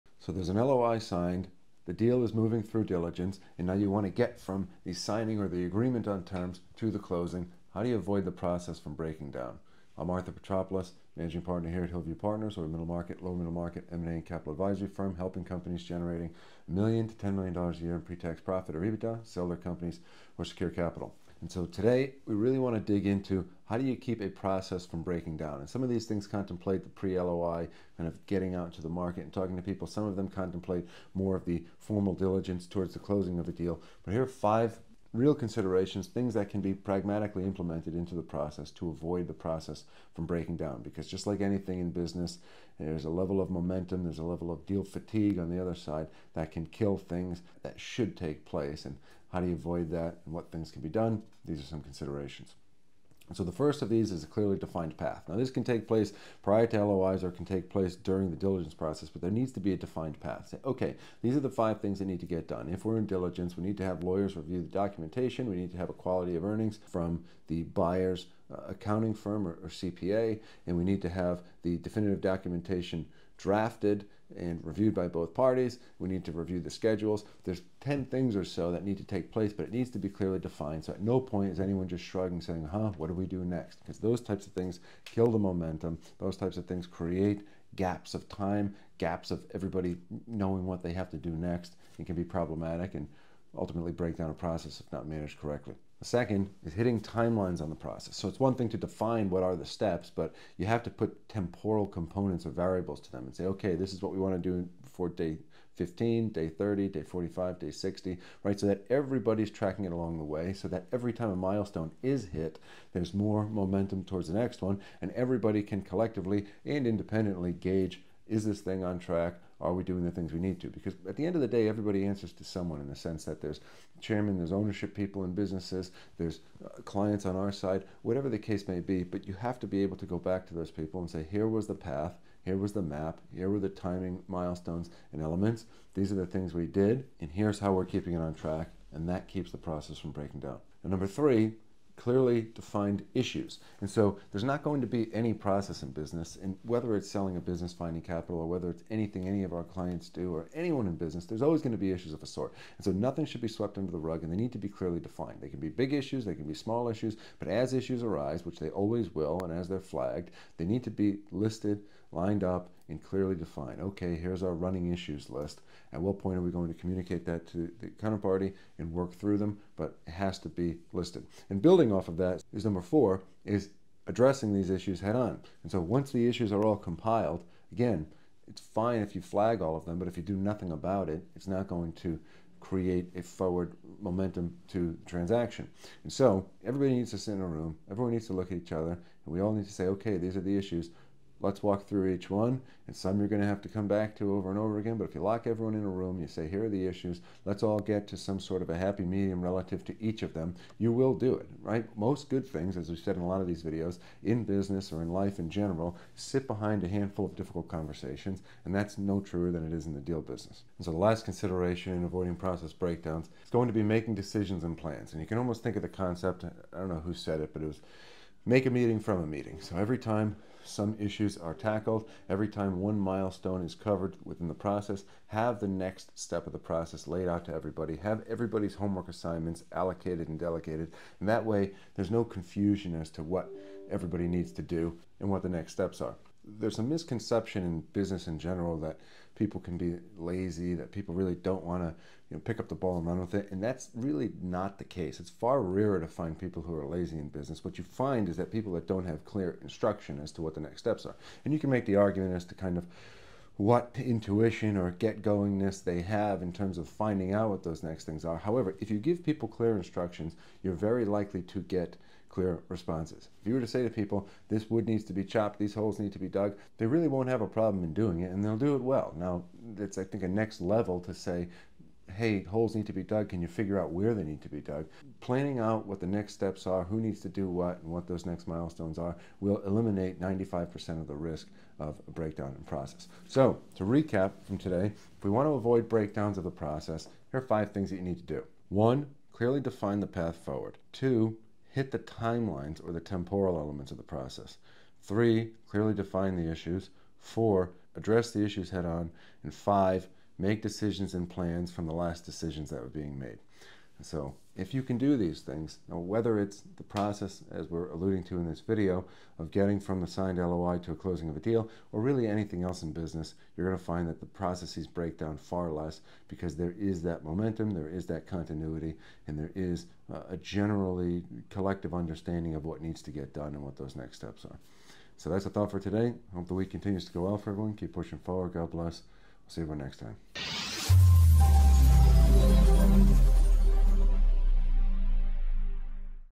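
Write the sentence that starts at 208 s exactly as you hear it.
And that's no truer than it is in the deal business.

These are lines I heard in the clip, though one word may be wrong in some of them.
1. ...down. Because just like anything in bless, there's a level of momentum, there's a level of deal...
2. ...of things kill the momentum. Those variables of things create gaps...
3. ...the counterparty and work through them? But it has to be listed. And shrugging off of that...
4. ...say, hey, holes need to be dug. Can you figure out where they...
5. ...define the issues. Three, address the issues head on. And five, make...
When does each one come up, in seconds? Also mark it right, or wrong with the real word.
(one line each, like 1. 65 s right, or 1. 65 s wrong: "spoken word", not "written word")
1. 40 s wrong: "business", not "bless"
2. 84 s wrong: "types", not "variables"
3. 167 s wrong: "building", not "shrugging"
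4. 271 s right
5. 295 s wrong: "Four", not "Three".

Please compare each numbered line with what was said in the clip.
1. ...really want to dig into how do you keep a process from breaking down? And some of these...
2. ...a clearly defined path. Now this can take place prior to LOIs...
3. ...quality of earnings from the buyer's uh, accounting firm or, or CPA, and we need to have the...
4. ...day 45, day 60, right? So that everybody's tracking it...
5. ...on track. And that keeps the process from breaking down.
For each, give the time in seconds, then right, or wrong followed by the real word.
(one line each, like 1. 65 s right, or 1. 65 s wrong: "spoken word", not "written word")
1. 22 s right
2. 54 s right
3. 65 s right
4. 106 s right
5. 138 s right.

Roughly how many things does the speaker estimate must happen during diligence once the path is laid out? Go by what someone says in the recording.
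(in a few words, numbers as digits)
10.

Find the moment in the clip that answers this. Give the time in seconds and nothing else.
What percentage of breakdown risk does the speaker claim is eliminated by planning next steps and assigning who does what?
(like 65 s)
280 s.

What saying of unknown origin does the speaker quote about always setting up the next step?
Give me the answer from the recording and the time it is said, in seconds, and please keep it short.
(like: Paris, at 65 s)
make a meeting from a meeting, at 218 s.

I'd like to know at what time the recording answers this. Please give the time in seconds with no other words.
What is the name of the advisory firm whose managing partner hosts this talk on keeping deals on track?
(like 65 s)
11 s.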